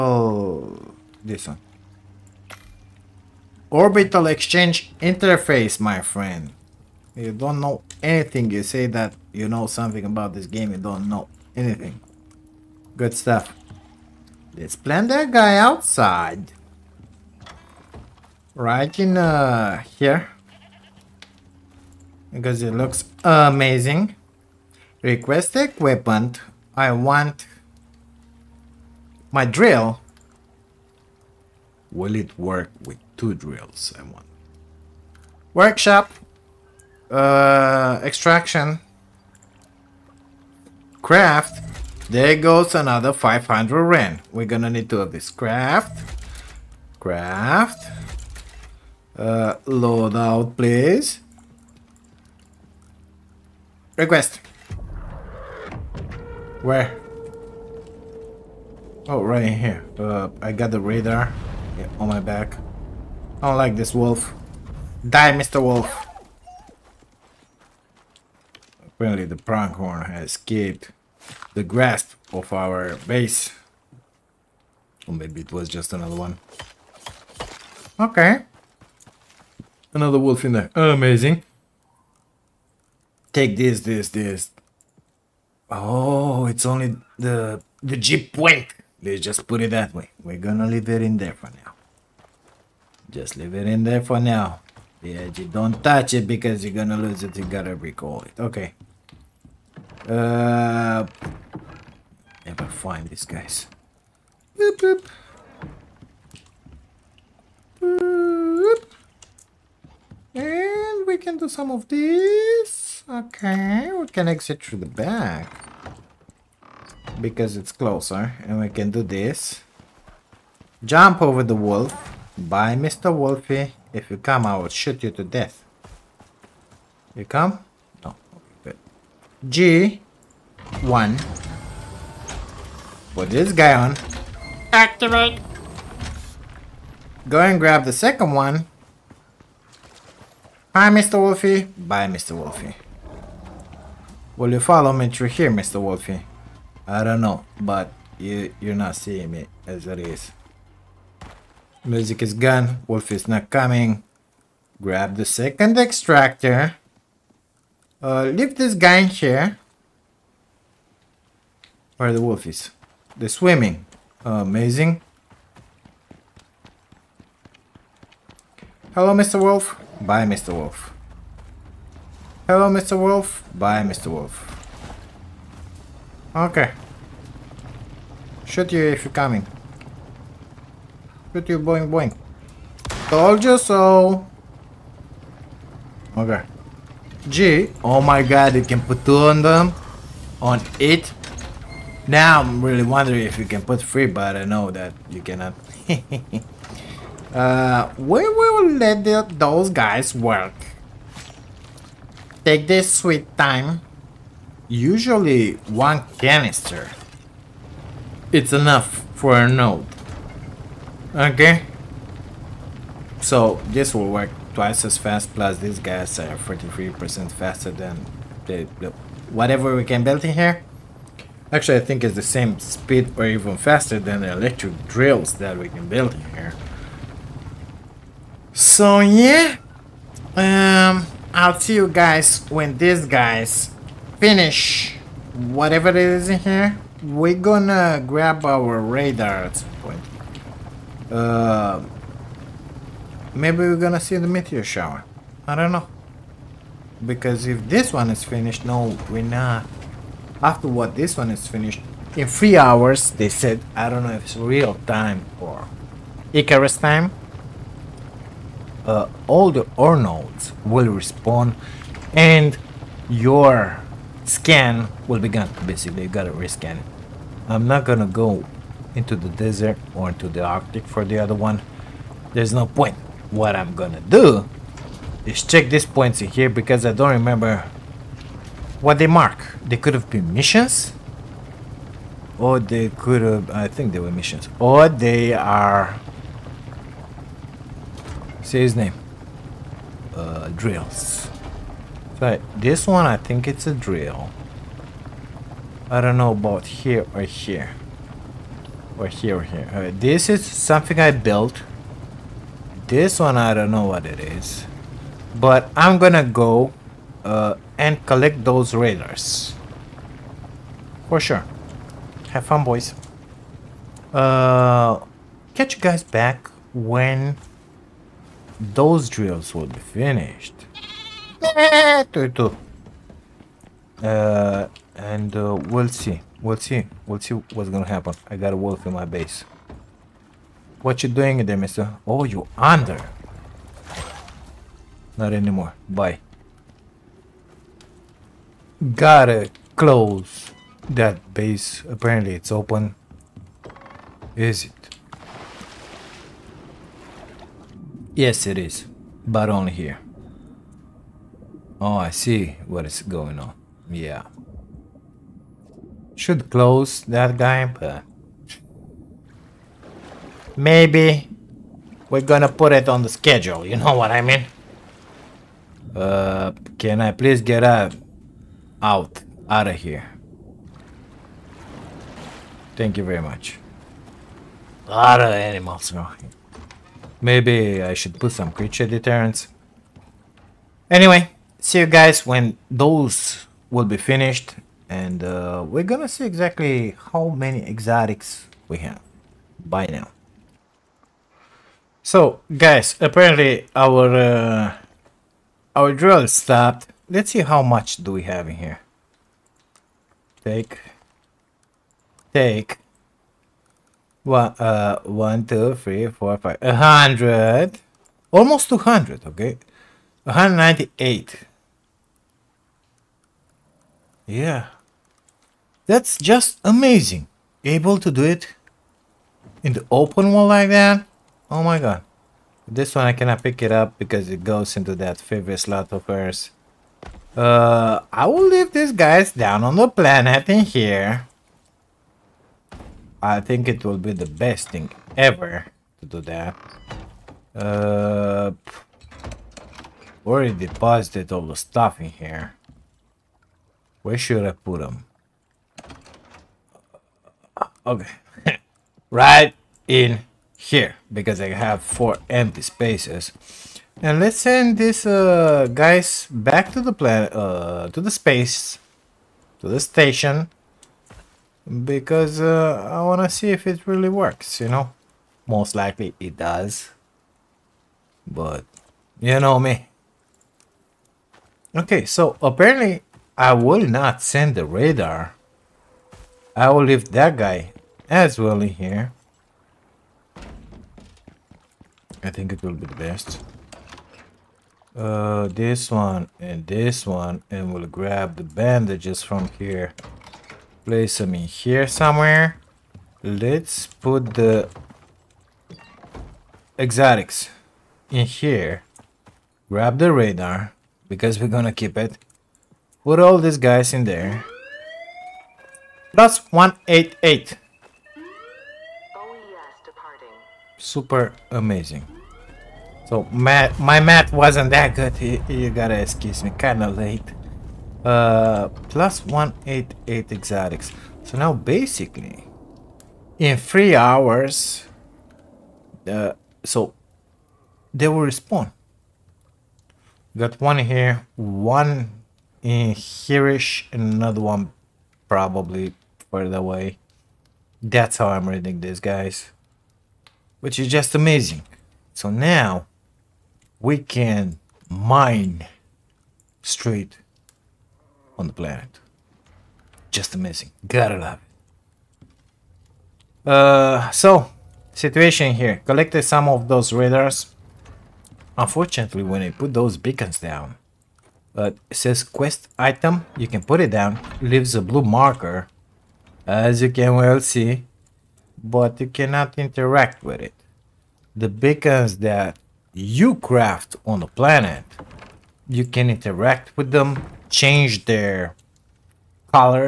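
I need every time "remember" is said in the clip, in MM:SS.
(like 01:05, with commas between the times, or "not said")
04:37.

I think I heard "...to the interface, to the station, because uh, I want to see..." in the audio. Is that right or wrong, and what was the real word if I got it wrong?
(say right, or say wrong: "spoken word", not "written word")
wrong: "space", not "interface".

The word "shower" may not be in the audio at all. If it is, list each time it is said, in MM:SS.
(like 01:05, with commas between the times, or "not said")
04:04.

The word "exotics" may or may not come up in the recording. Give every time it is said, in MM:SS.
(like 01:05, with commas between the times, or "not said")
06:27, 08:16, 08:40.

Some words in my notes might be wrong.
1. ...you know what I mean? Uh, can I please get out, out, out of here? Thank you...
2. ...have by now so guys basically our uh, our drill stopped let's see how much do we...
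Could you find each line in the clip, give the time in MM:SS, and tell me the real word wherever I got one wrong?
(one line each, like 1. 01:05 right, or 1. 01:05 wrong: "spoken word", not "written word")
1. 06:03 right
2. 06:28 wrong: "apparently", not "basically".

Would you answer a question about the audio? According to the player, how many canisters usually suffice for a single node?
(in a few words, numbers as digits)
one canister.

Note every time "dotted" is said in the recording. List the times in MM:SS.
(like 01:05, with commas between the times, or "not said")
not said.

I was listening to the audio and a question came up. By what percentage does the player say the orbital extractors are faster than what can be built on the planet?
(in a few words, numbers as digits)
43%.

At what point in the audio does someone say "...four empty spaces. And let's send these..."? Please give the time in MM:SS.
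07:31.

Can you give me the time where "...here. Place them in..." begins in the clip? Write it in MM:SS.
08:09.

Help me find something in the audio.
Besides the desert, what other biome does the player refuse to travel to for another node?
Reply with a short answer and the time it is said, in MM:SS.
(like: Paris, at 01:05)
Arctic, at 04:30.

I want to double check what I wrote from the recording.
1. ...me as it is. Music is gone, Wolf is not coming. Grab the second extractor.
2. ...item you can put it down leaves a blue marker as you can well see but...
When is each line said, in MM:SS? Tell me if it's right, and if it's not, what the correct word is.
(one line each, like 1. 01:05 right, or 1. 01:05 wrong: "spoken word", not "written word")
1. 02:29 right
2. 09:22 right.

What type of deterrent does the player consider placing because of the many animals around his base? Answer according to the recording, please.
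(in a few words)
creature deterrents.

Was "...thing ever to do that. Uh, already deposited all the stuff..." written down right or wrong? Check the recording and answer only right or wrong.
right.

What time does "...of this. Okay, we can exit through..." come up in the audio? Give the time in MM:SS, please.
01:51.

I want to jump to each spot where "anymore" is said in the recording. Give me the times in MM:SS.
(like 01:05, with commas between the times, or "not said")
05:35.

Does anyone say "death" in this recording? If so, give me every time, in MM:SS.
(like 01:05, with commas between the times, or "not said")
02:05.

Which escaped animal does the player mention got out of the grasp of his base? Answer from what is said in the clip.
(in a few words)
pronghorn.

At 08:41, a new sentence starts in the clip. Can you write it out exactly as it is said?
So now basically, in three hours, uh, so they will respawn.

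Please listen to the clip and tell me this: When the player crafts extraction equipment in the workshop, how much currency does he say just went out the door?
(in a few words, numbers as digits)
500 ren.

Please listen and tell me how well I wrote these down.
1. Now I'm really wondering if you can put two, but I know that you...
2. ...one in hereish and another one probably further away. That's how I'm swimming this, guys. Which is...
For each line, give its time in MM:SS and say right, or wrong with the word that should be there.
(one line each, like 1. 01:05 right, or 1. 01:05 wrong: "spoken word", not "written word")
1. 03:12 wrong: "three", not "two"
2. 08:51 wrong: "reading", not "swimming".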